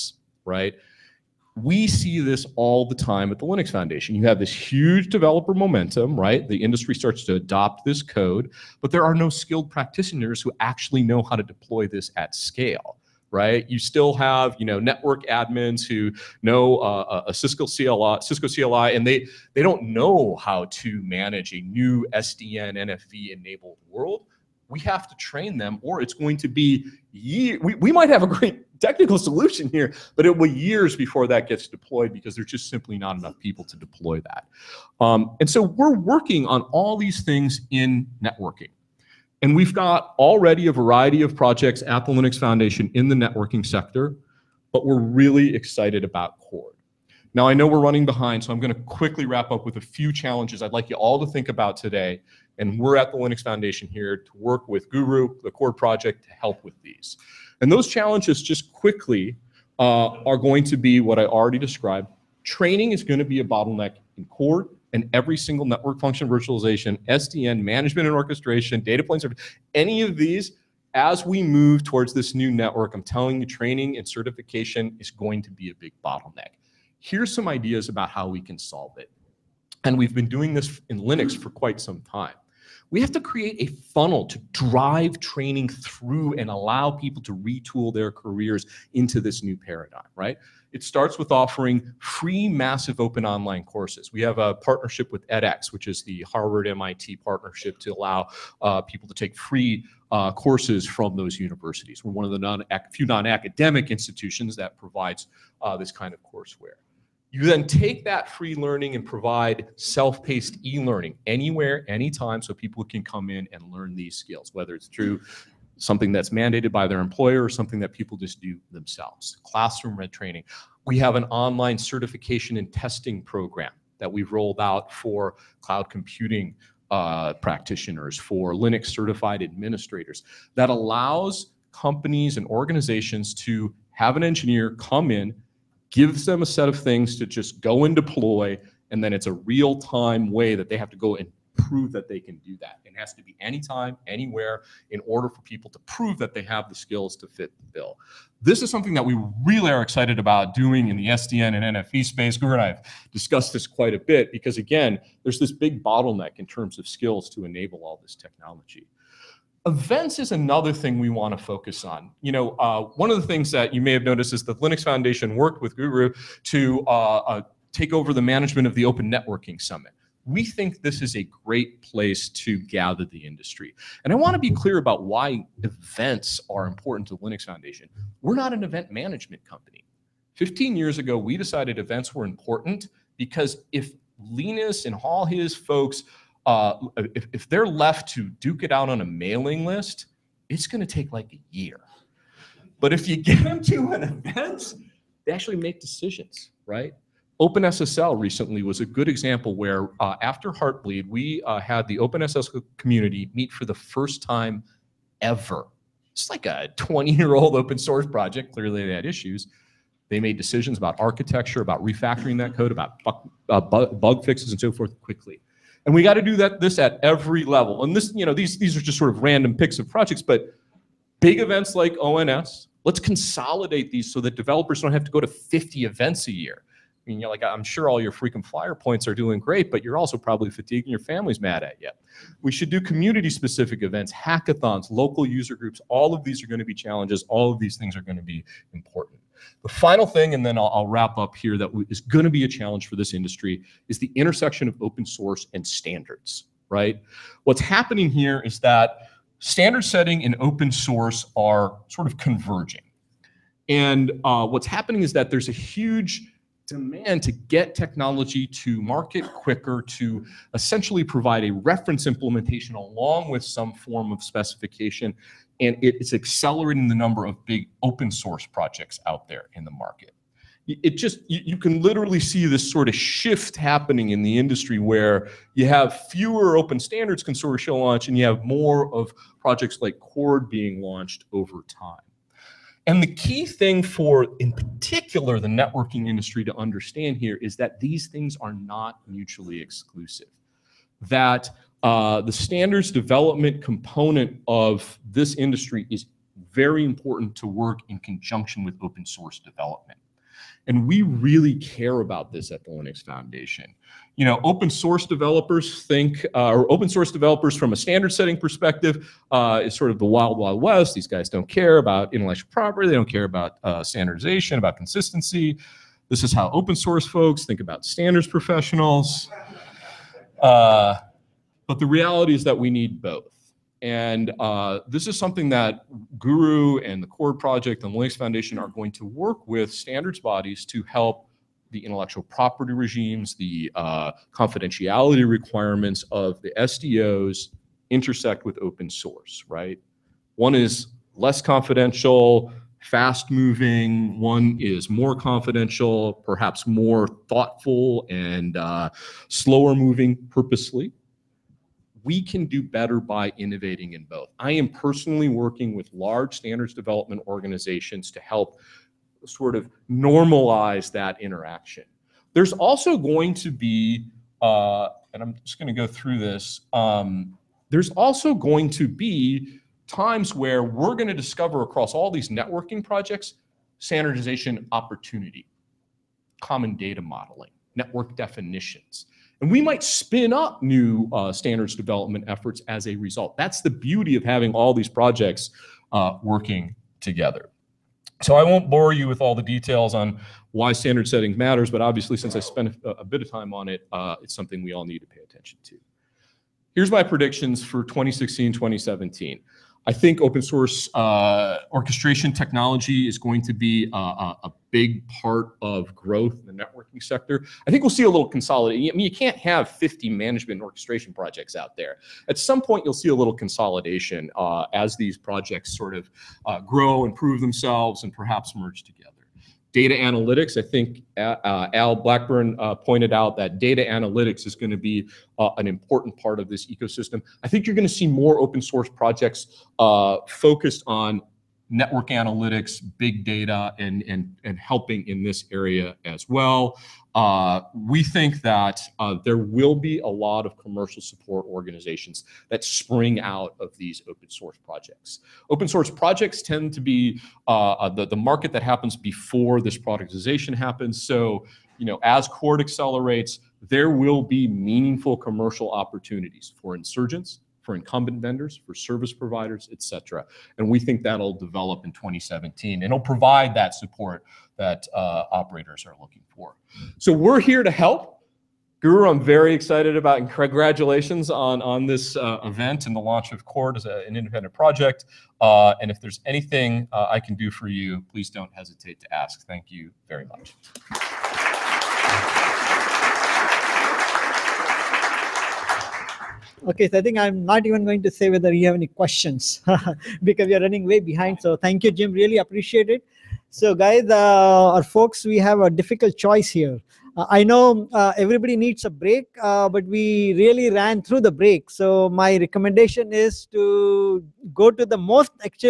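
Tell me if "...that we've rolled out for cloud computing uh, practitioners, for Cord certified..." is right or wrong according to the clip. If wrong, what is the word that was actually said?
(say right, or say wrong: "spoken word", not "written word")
wrong: "Linux", not "Cord".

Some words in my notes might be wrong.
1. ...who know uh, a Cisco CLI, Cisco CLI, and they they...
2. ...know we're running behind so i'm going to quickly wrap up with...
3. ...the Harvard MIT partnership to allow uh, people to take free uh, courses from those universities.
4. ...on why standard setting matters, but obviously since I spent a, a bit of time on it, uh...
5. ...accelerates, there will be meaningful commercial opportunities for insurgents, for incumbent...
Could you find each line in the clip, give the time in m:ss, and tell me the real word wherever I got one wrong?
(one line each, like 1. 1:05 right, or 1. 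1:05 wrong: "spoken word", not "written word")
1. 0:15 right
2. 0:47 right
3. 1:36 right
4. 6:29 right
5. 7:32 right.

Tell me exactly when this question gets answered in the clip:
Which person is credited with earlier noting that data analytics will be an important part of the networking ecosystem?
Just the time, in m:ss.
7:01.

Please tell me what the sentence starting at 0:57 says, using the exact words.
And those challenges, just quickly, uh, are going to be what I already described.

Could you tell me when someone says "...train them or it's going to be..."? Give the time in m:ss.
0:25.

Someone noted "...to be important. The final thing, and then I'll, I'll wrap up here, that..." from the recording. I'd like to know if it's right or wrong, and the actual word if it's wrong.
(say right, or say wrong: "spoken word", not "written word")
right.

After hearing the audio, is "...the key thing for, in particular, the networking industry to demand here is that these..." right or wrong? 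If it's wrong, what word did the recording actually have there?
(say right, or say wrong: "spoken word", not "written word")
wrong: "understand", not "demand".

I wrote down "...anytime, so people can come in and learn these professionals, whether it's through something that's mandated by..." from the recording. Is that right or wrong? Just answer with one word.
wrong.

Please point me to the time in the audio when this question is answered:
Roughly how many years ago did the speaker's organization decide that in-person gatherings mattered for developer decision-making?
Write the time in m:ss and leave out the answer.
3:00.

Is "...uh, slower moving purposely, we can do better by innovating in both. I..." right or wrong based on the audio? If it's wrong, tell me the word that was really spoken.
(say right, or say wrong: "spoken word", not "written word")
right.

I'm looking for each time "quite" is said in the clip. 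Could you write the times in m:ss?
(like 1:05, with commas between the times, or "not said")
1:21, 2:33.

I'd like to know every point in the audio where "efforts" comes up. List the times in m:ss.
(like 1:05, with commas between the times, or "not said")
6:22.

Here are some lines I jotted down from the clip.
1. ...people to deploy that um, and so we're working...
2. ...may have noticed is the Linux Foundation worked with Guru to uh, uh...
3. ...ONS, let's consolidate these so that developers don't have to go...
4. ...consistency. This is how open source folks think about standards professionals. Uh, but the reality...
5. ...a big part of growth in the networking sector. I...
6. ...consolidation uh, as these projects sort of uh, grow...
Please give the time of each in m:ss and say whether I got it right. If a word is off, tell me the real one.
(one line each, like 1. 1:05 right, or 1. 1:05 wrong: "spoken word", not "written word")
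1. 0:33 right
2. 2:43 right
3. 3:42 right
4. 5:14 right
5. 6:44 right
6. 6:53 right.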